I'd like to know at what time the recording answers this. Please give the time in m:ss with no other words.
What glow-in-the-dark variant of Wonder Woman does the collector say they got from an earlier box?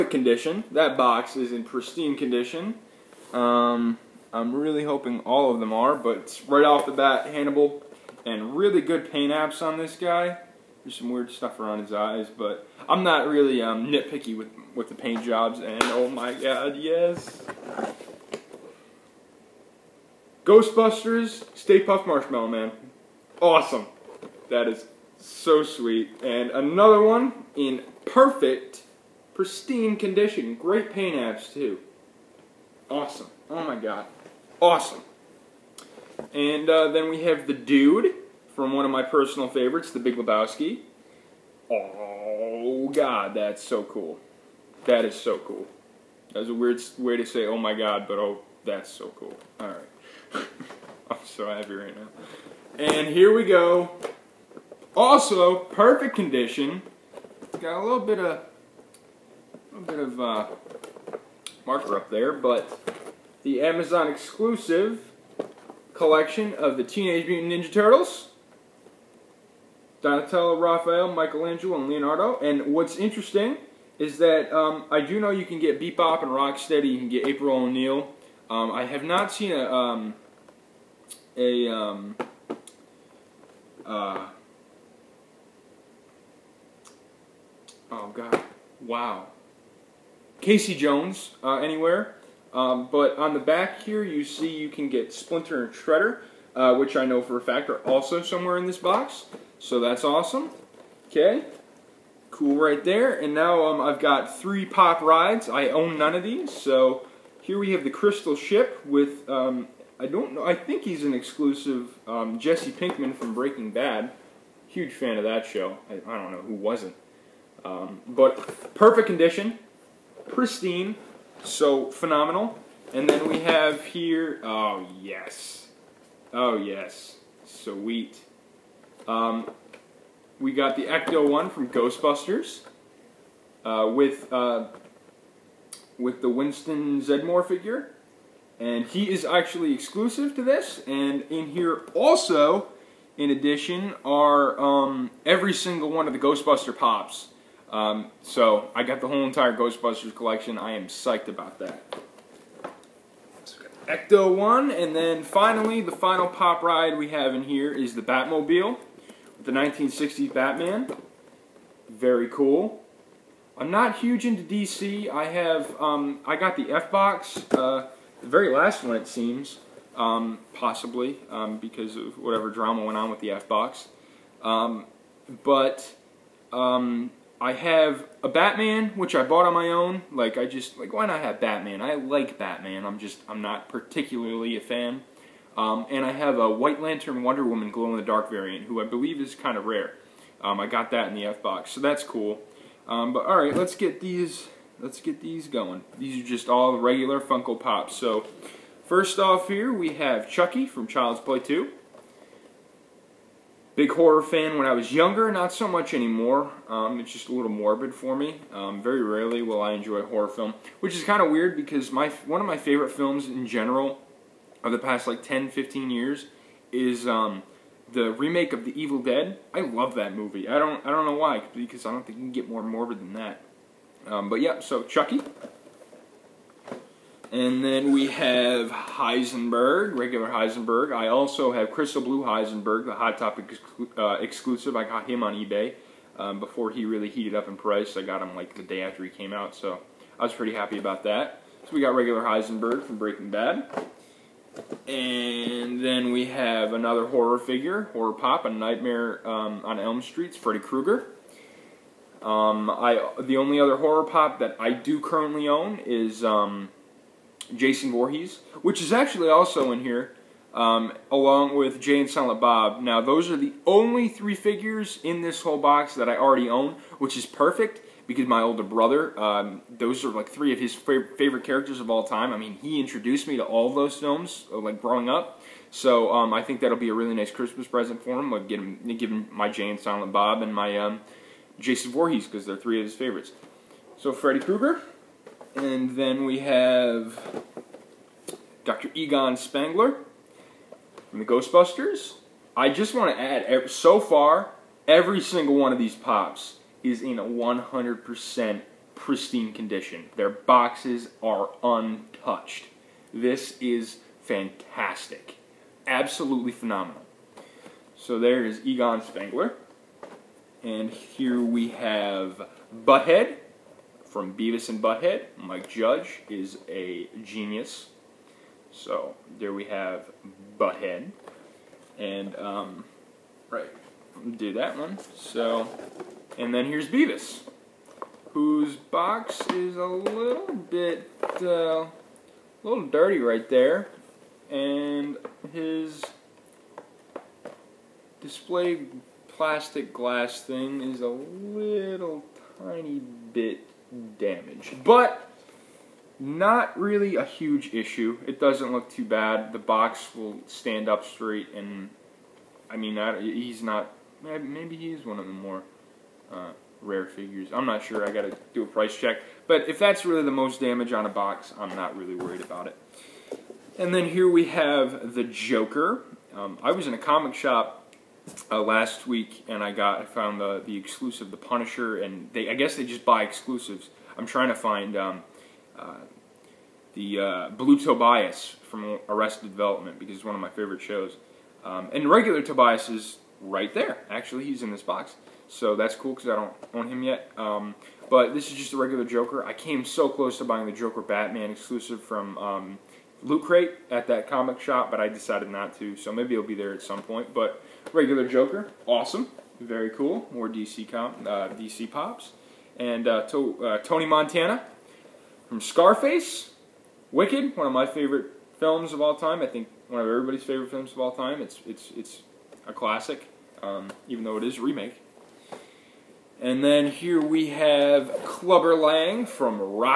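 3:06.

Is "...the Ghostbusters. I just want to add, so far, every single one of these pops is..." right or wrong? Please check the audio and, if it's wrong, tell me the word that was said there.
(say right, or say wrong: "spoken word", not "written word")
right.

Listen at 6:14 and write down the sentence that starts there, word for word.
I'm trying to find um, uh, the uh, Blue Tobias from Arrested Development because it's one of my favorite shows.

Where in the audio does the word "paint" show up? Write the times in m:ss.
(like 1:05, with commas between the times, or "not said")
0:09, 0:14, 0:30.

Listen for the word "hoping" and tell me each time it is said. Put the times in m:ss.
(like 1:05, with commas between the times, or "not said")
0:04.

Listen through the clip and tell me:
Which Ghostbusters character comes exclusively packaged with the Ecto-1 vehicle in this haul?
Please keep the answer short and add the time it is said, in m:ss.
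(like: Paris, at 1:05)
Winston Zeddemore, at 2:16.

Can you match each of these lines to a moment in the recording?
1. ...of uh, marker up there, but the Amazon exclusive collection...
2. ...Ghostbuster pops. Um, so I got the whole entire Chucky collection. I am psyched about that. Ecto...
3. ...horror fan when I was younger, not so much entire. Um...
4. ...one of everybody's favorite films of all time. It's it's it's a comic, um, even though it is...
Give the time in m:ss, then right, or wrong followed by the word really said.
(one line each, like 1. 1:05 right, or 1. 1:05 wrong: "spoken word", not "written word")
1. 0:59 right
2. 2:26 wrong: "Ghostbusters", not "Chucky"
3. 3:23 wrong: "anymore", not "entire"
4. 6:49 wrong: "classic", not "comic".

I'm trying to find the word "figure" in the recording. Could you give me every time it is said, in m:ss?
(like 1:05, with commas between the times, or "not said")
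2:17, 4:07, 4:24, 5:57.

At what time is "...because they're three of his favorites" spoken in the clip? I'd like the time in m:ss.
4:42.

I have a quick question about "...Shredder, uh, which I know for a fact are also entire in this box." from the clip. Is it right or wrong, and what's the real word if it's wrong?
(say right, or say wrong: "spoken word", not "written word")
wrong: "somewhere", not "entire".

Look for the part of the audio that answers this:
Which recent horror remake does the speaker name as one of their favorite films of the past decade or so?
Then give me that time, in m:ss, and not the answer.
3:38.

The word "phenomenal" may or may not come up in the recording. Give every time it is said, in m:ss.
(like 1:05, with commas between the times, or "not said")
2:01, 5:06.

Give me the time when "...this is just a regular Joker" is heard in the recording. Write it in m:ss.
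6:28.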